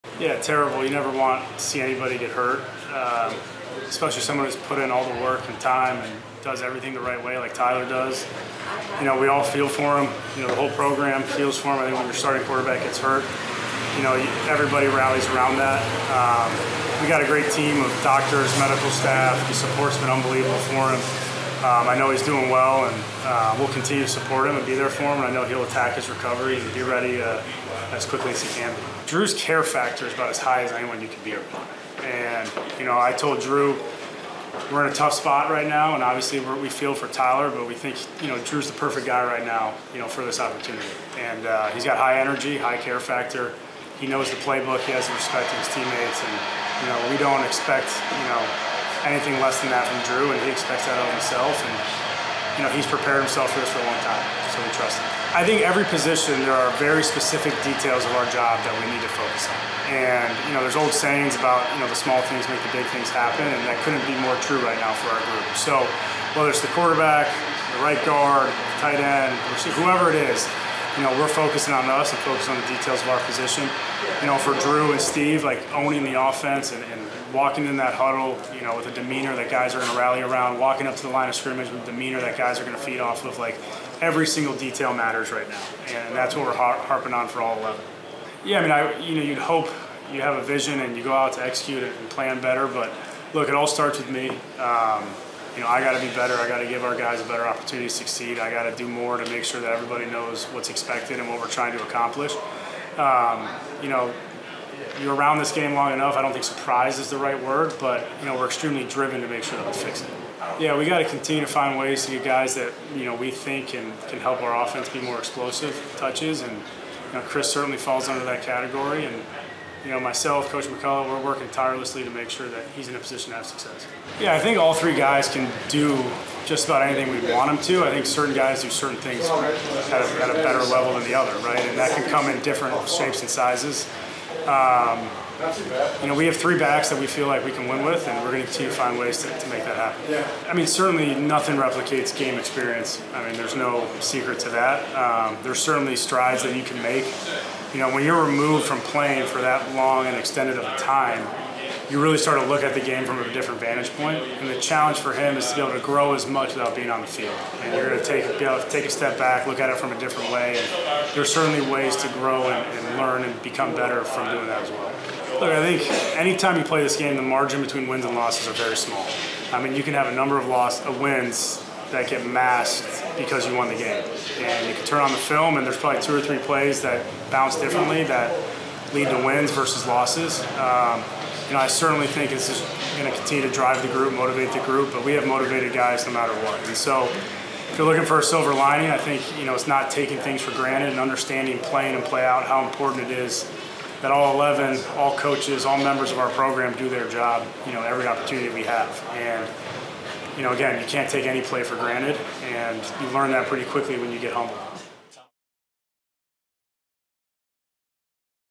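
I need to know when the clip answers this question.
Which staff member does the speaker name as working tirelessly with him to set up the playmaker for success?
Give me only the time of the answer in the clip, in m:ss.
2:00.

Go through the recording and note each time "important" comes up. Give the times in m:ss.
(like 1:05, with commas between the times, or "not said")
3:12.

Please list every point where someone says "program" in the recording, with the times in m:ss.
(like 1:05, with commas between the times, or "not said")
0:10, 3:16.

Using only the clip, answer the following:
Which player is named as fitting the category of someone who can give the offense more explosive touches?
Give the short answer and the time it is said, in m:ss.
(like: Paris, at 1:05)
Chris, at 1:57.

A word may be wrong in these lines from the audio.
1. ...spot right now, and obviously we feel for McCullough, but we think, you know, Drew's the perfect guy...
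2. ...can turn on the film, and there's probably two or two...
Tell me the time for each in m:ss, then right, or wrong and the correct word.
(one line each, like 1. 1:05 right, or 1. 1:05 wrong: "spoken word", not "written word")
1. 0:35 wrong: "Tyler", not "McCullough"
2. 2:54 wrong: "three", not "two".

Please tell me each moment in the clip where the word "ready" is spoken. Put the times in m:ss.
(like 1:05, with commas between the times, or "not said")
0:26.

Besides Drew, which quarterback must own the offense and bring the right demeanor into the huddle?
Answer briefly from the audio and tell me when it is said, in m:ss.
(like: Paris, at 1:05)
Steve, at 1:15.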